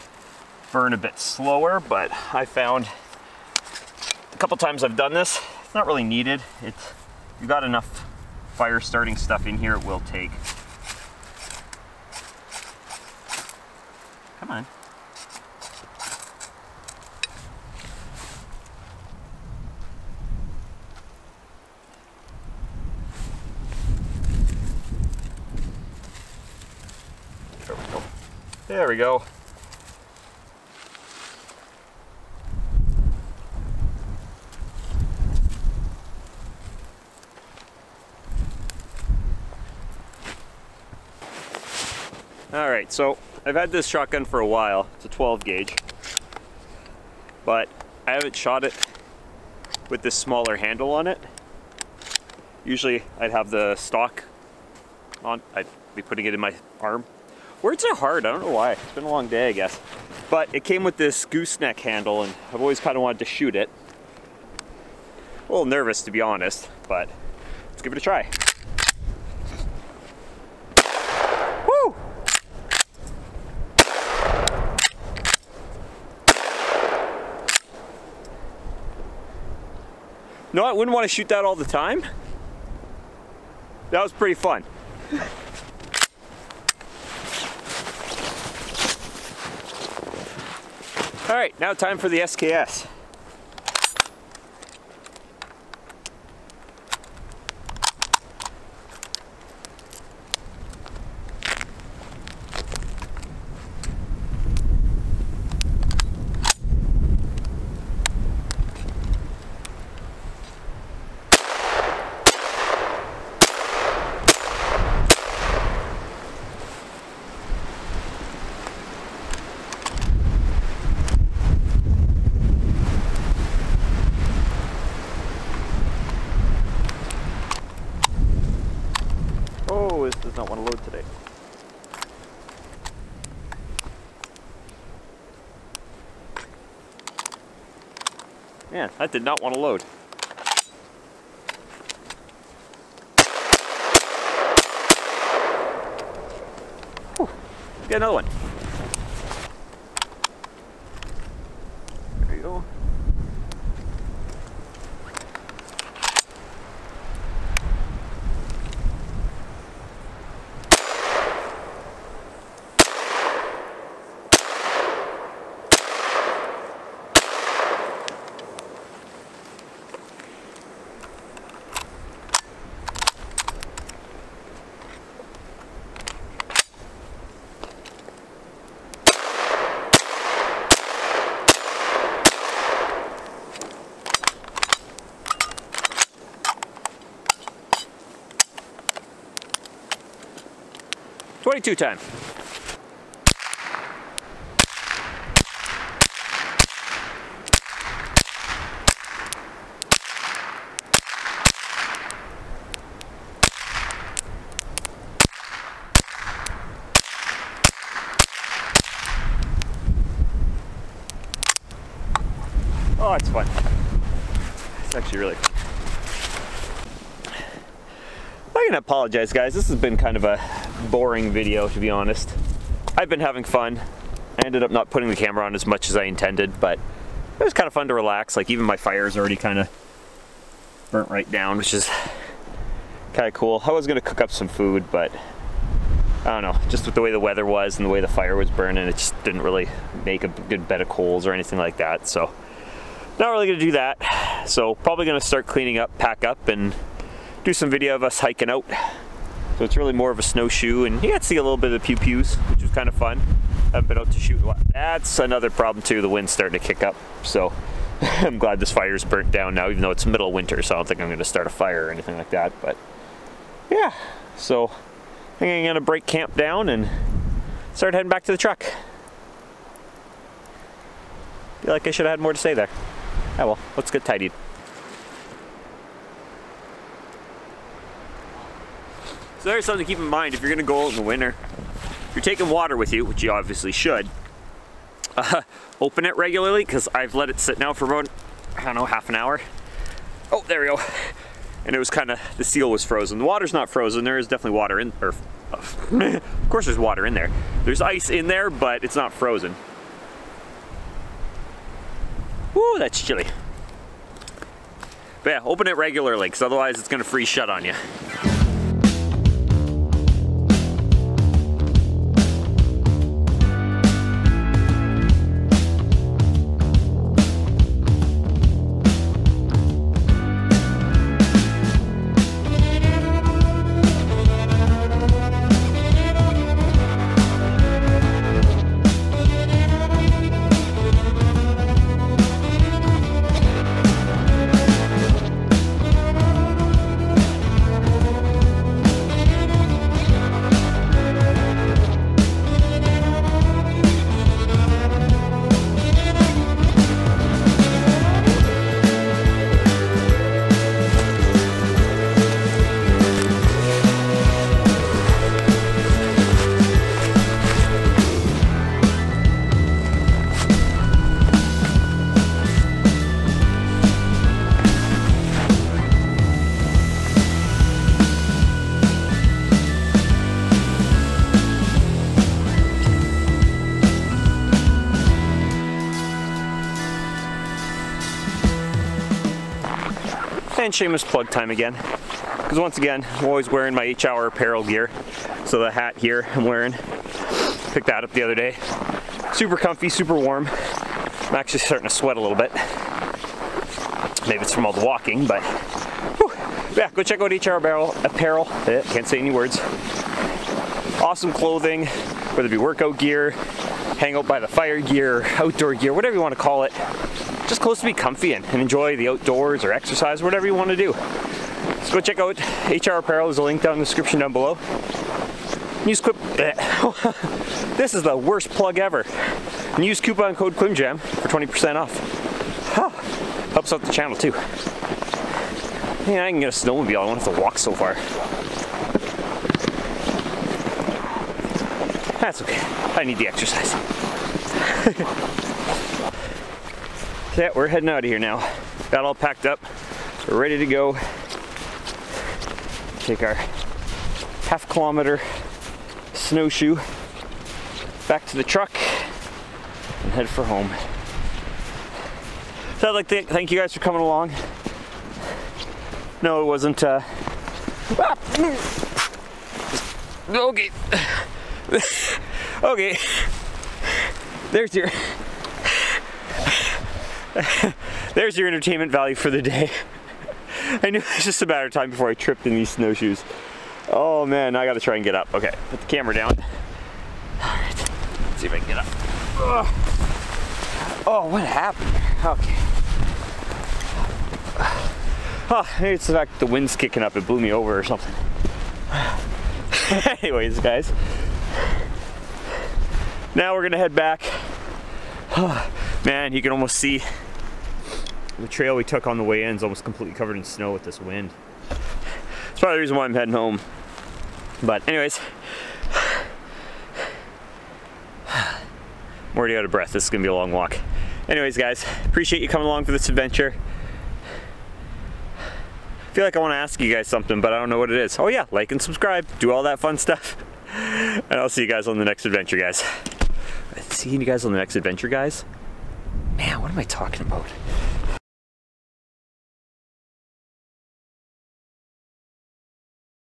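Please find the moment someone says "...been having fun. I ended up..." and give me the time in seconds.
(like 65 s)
223 s.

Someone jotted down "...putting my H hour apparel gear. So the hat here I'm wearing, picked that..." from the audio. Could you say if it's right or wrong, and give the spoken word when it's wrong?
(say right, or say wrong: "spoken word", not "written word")
wrong: "wearing", not "putting".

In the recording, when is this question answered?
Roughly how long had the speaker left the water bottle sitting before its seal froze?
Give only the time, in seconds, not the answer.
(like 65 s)
288 s.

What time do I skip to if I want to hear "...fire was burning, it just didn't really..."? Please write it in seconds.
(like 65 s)
238 s.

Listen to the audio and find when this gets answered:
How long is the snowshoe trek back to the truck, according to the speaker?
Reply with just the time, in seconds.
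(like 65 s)
444 s.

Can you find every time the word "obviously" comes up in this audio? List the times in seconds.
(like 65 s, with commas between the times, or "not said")
283 s.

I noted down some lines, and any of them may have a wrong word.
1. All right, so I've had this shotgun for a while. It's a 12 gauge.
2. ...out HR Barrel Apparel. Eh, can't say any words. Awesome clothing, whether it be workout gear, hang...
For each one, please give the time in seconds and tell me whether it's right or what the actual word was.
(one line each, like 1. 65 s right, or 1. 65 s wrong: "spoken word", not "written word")
1. 42 s right
2. 397 s right.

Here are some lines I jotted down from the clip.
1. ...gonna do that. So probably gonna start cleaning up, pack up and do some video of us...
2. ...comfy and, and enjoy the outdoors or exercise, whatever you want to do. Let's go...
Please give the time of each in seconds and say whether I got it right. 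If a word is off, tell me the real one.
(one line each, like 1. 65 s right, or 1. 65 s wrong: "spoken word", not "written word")
1. 243 s right
2. 407 s right.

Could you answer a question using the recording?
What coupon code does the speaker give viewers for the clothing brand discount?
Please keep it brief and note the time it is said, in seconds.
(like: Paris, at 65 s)
Kwmjam, at 420 s.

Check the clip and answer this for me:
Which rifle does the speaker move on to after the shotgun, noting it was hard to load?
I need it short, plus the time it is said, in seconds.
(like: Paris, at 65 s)
SKS, at 92 s.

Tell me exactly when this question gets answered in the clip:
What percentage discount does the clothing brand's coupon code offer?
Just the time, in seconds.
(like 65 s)
421 s.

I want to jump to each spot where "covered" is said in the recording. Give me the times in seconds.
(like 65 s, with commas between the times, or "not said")
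500 s.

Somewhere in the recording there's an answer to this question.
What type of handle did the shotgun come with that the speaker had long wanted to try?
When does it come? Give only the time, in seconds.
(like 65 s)
61 s.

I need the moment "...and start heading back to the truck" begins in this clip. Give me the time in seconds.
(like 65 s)
266 s.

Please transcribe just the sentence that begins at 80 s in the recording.
No, I wouldn't want to shoot that all the time.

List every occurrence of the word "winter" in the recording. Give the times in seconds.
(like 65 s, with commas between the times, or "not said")
260 s, 281 s.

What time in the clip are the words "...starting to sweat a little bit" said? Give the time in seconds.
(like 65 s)
391 s.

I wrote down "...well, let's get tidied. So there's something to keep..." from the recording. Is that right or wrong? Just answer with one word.
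right.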